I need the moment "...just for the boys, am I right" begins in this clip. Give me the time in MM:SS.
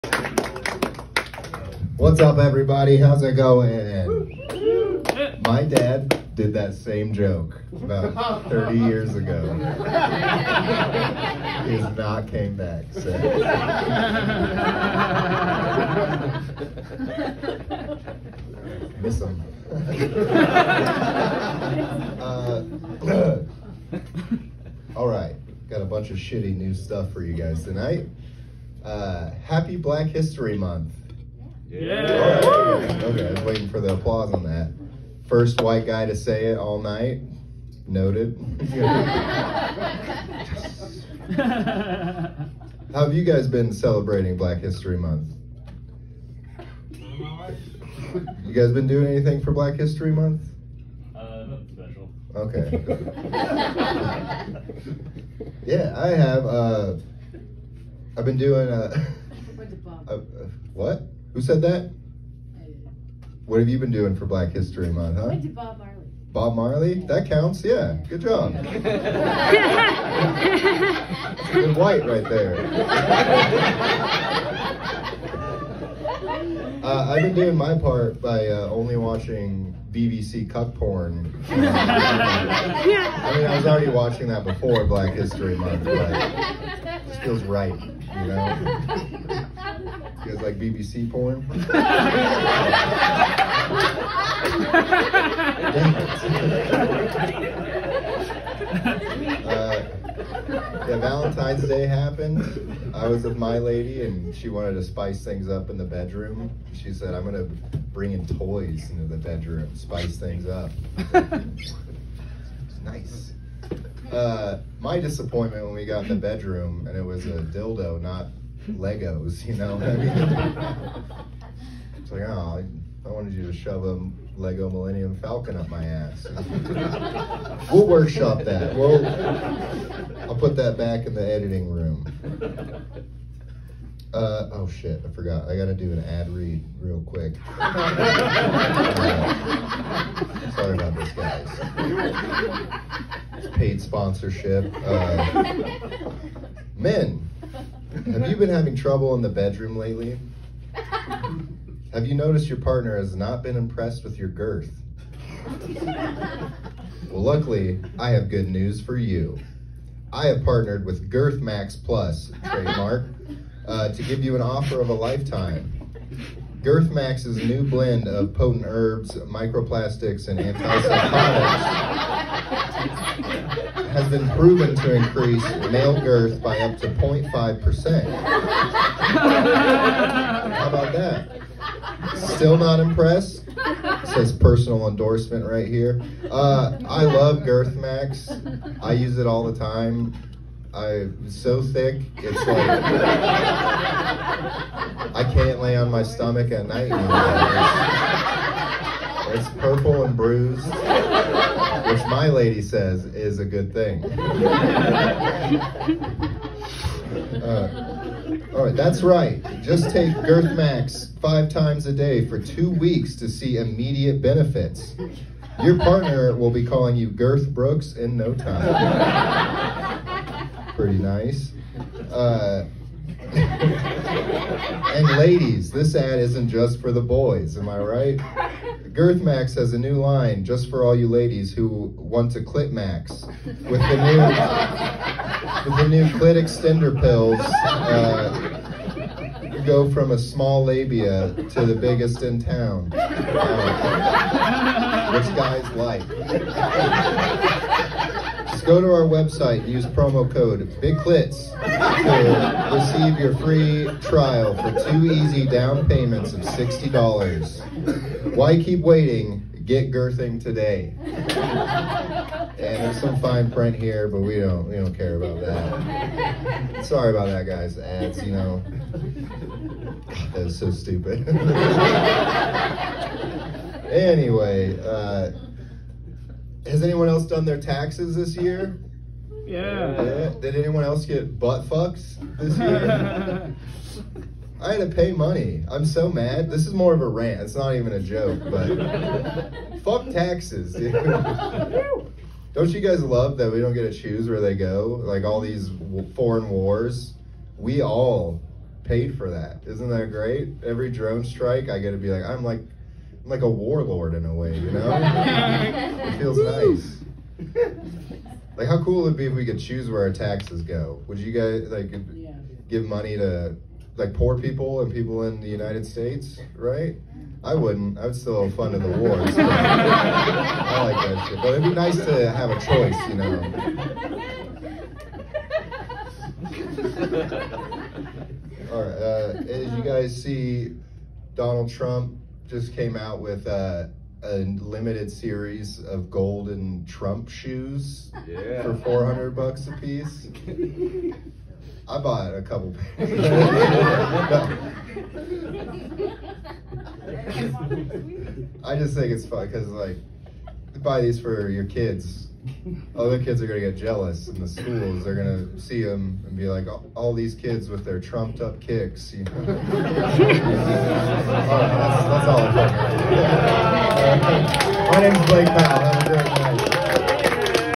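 03:46.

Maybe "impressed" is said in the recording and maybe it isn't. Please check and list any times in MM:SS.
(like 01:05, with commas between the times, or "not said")
02:33, 03:02.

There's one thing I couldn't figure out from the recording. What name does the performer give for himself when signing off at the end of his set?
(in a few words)
Blake Powell.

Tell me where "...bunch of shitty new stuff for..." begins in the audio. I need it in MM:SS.
00:25.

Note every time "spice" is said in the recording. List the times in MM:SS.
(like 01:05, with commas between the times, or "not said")
01:44, 01:49.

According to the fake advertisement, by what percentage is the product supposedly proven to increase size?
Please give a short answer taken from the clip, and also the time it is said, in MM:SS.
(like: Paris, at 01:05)
0.5%, at 02:56.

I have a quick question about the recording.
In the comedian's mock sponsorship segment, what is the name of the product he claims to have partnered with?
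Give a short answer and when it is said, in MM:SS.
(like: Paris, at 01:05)
Girth Max Plus, at 02:41.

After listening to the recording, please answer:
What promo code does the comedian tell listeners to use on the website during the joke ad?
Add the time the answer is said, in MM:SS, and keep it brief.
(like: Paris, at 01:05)
BIGCLITS, at 04:10.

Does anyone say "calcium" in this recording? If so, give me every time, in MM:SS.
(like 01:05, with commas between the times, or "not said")
not said.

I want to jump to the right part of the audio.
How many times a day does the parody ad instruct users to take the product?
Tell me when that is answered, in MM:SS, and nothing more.
03:31.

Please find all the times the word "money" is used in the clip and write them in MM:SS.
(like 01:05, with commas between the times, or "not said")
04:45, 05:12.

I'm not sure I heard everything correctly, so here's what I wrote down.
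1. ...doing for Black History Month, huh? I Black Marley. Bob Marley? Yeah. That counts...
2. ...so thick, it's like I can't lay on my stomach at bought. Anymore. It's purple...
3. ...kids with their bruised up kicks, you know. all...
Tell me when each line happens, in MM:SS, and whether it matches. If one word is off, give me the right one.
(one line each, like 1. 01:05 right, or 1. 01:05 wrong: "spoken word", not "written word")
1. 01:03 wrong: "Bob", not "Black"
2. 03:11 wrong: "night", not "bought"
3. 05:57 wrong: "trumped", not "bruised".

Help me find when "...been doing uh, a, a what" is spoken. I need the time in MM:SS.
00:58.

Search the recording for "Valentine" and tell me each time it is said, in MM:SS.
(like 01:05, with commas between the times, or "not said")
01:40.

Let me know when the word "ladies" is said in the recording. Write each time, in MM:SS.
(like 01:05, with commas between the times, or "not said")
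03:45, 03:51.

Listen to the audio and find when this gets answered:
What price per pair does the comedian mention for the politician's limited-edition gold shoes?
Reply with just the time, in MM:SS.
05:38.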